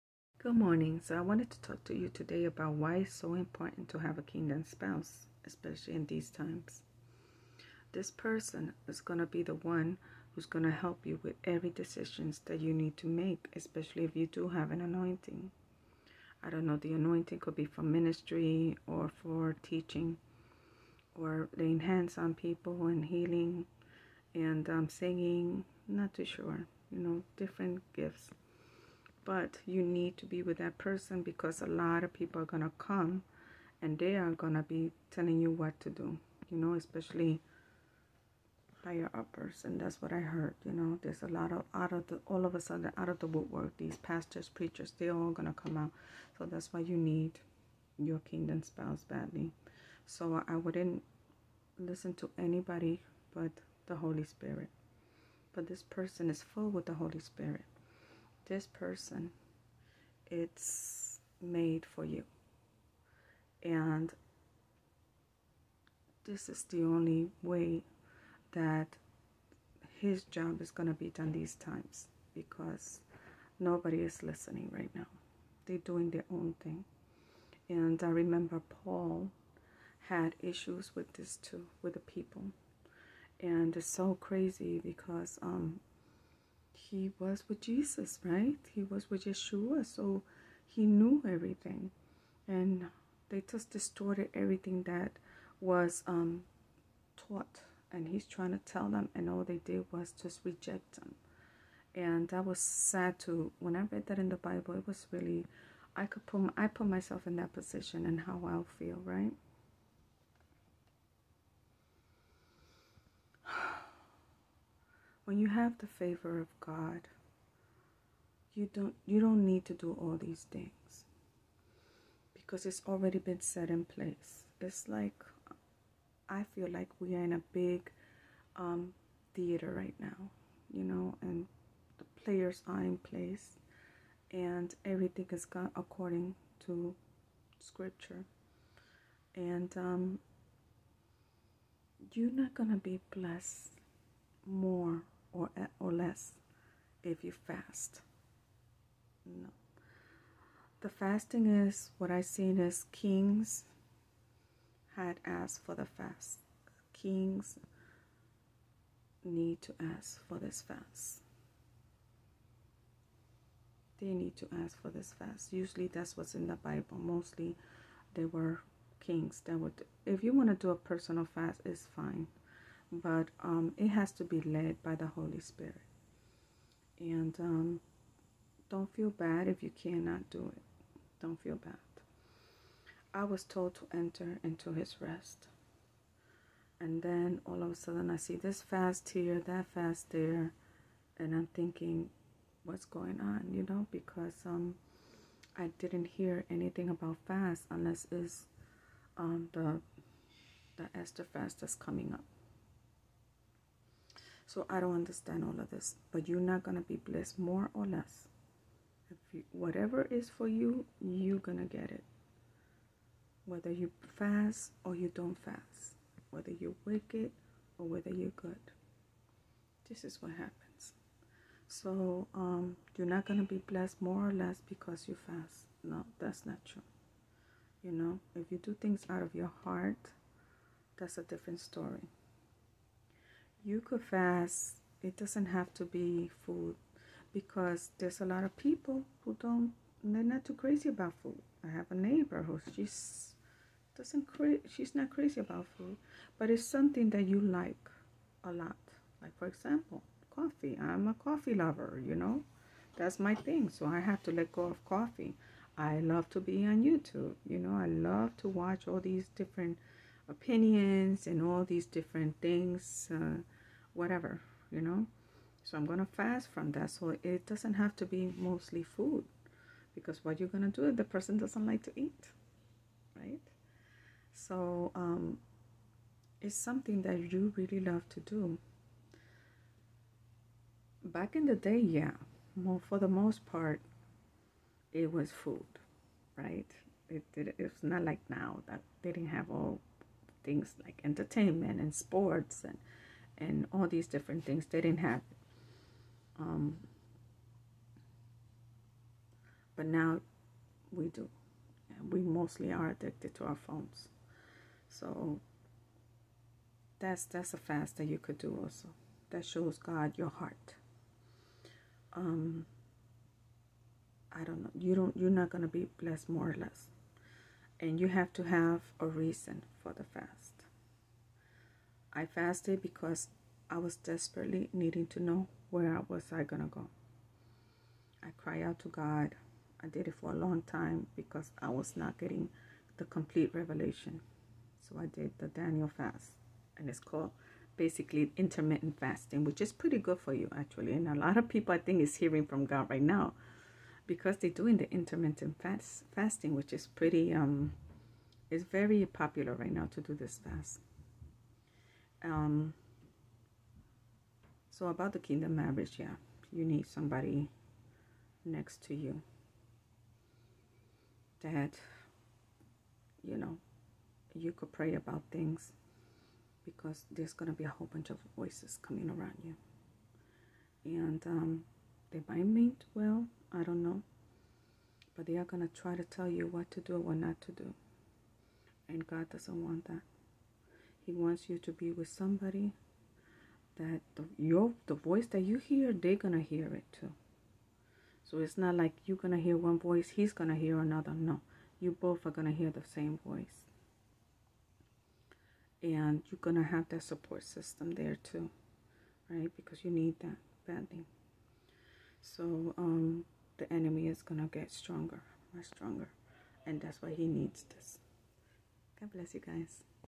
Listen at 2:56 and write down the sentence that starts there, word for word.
And um, don't feel bad if you cannot do it.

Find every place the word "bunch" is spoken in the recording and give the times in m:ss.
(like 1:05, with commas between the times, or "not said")
6:07.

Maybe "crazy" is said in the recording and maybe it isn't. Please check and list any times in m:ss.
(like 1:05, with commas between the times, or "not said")
1:24, 4:00, 4:05.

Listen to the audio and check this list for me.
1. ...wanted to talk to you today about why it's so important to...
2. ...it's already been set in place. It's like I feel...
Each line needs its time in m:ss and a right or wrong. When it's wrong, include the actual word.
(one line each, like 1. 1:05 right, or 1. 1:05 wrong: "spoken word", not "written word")
1. 0:01 right
2. 2:02 right.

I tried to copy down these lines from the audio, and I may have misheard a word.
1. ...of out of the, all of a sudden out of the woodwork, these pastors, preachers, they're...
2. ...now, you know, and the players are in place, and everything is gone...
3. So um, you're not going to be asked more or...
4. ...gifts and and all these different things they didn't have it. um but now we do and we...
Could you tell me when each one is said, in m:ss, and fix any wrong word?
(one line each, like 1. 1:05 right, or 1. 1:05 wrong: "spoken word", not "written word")
1. 0:41 right
2. 2:10 right
3. 3:41 wrong: "blessed", not "asked"
4. 4:51 wrong: "sports", not "gifts".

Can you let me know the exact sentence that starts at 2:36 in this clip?
Kings need to ask for this fast.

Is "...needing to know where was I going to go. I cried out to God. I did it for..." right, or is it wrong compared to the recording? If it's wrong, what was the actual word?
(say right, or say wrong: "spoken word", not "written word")
right.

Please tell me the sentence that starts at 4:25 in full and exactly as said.
So I'm going to fast from that.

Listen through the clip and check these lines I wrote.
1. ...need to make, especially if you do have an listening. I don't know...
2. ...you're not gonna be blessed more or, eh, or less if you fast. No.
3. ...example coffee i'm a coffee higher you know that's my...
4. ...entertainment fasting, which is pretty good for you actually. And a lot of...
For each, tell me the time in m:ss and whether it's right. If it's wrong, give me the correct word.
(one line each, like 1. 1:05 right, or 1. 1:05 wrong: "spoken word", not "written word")
1. 0:12 wrong: "anointing", not "listening"
2. 2:22 right
3. 4:09 wrong: "lover", not "higher"
4. 5:38 wrong: "intermittent", not "entertainment".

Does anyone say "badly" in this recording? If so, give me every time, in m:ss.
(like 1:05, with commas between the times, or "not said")
0:49, 6:40.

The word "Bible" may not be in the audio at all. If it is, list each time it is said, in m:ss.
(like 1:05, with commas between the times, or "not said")
1:44, 2:46.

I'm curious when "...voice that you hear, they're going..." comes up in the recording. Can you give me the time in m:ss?
6:24.